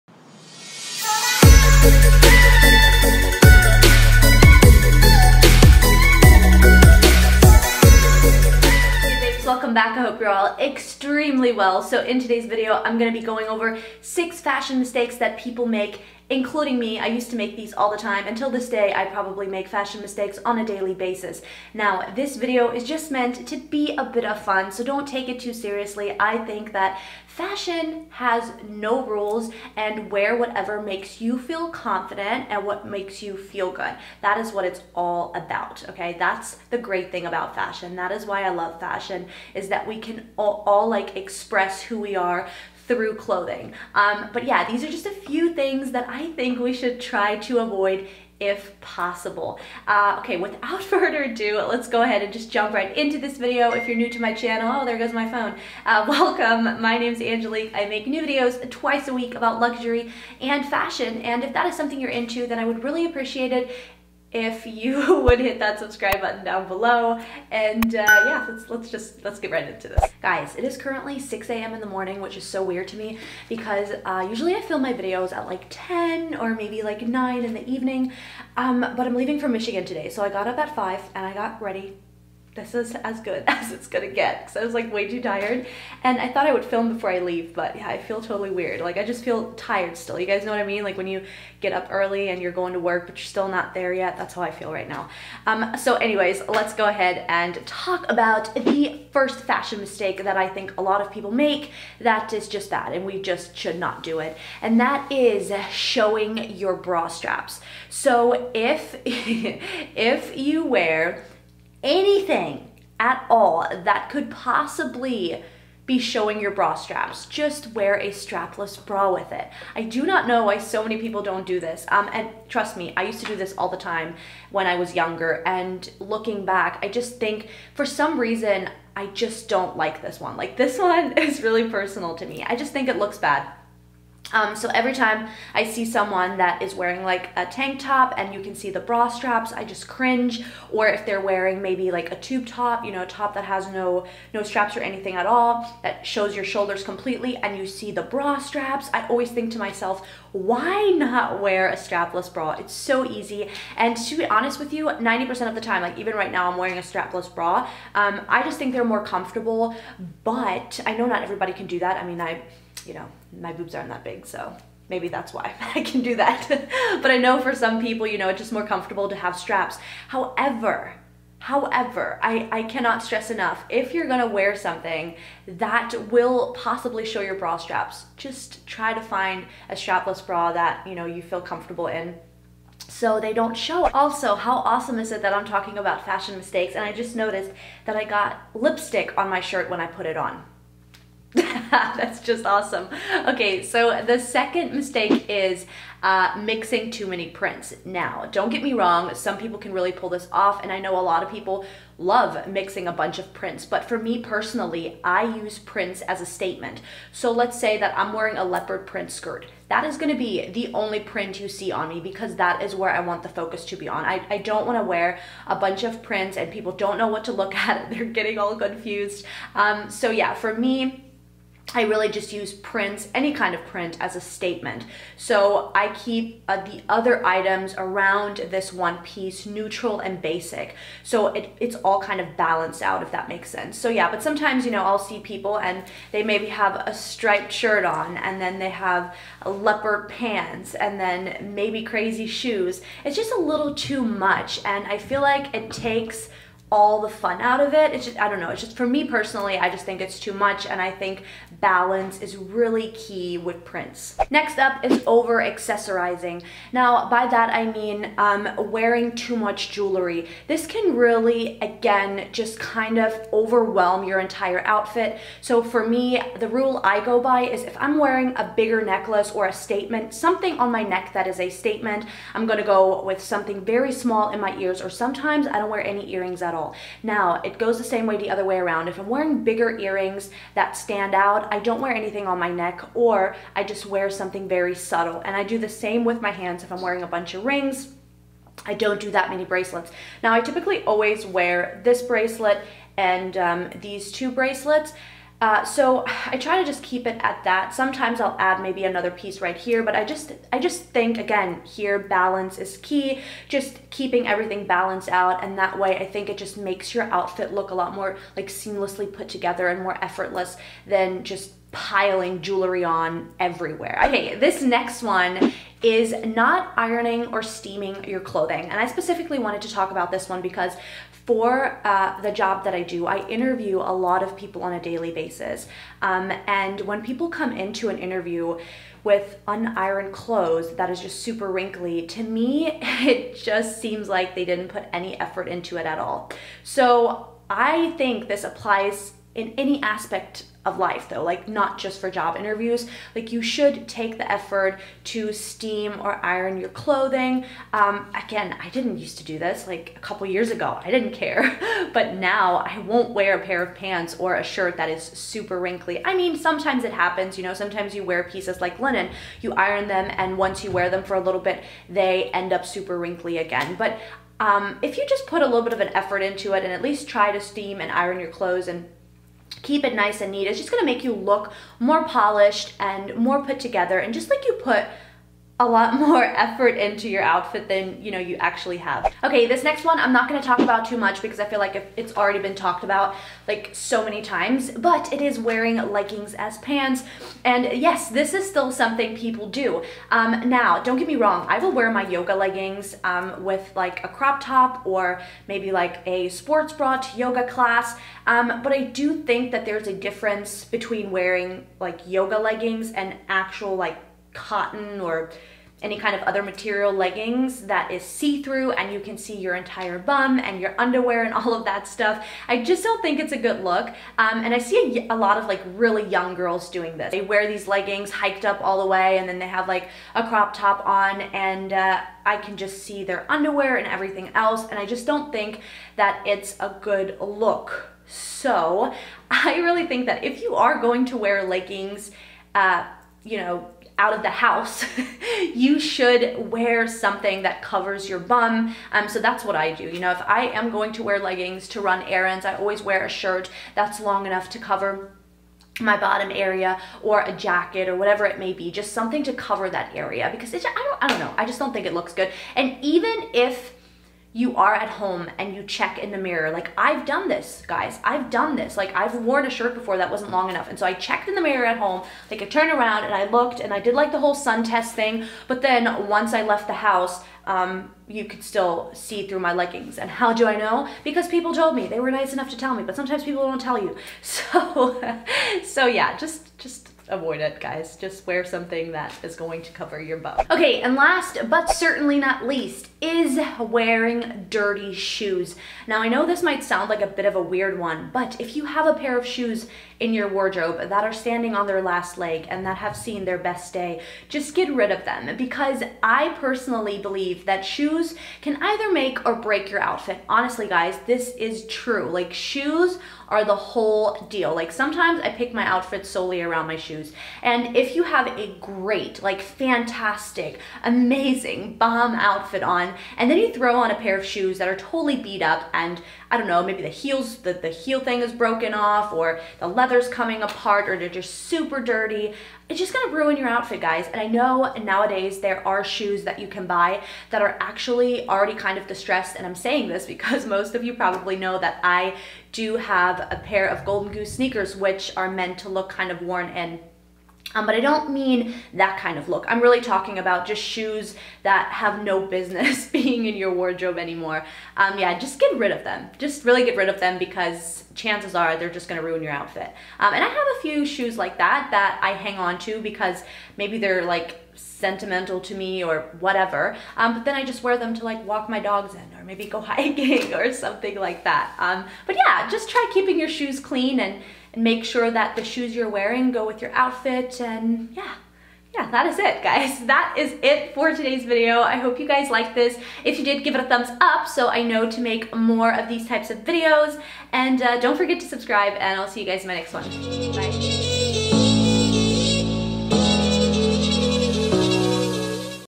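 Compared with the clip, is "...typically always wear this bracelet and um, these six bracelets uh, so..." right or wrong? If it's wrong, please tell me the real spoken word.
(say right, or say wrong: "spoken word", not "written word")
wrong: "two", not "six".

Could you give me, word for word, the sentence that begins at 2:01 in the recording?
Um, and trust me, I used to do this all the time when I was younger.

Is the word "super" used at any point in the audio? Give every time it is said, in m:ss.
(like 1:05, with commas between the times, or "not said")
5:31, 5:55, 6:02, 8:41.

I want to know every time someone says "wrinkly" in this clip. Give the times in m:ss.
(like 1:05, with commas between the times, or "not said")
5:31, 5:55, 6:02.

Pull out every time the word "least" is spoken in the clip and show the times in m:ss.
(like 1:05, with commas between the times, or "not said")
6:06, 8:02.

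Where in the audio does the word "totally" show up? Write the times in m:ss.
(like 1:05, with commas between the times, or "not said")
1:28, 8:34.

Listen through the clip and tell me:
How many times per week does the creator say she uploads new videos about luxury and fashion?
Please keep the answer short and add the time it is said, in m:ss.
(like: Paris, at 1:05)
Twice a week, at 0:58.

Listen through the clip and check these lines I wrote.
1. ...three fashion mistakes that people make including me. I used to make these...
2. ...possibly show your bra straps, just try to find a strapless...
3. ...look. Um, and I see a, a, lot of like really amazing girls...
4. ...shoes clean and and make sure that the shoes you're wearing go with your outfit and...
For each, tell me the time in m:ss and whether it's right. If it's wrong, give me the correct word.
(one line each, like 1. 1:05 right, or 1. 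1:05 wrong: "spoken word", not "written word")
1. 0:14 wrong: "six", not "three"
2. 2:56 right
3. 6:53 wrong: "young", not "amazing"
4. 9:23 right.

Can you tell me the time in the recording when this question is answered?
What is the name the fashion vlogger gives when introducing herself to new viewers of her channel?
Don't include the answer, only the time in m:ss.
0:57.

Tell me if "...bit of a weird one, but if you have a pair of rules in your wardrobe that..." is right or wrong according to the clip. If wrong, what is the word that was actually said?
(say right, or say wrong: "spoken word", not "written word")
wrong: "shoes", not "rules".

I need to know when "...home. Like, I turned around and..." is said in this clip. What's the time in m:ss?
7:41.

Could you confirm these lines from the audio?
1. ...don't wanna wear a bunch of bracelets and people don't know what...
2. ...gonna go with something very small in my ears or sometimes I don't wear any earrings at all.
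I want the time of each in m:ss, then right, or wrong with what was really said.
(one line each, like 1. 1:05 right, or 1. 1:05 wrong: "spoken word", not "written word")
1. 3:34 wrong: "prints", not "bracelets"
2. 4:32 right.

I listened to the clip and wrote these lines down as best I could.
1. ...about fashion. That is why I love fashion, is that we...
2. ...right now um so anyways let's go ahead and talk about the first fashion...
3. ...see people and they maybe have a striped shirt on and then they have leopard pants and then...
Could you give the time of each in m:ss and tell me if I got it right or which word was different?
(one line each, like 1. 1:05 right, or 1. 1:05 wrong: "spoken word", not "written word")
1. 0:37 right
2. 1:34 right
3. 3:54 right.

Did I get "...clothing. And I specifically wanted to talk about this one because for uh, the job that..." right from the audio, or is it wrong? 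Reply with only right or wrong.
right.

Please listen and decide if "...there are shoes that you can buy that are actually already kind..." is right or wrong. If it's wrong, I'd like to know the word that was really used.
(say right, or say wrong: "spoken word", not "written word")
right.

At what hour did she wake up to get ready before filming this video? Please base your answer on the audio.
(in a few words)
5.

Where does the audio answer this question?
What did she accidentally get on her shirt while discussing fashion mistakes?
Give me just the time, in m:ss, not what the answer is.
3:08.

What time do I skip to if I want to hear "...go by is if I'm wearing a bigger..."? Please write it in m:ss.
4:27.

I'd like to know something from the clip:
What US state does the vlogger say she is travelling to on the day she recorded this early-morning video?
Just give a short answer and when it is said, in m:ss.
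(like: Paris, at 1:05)
Michigan, at 1:19.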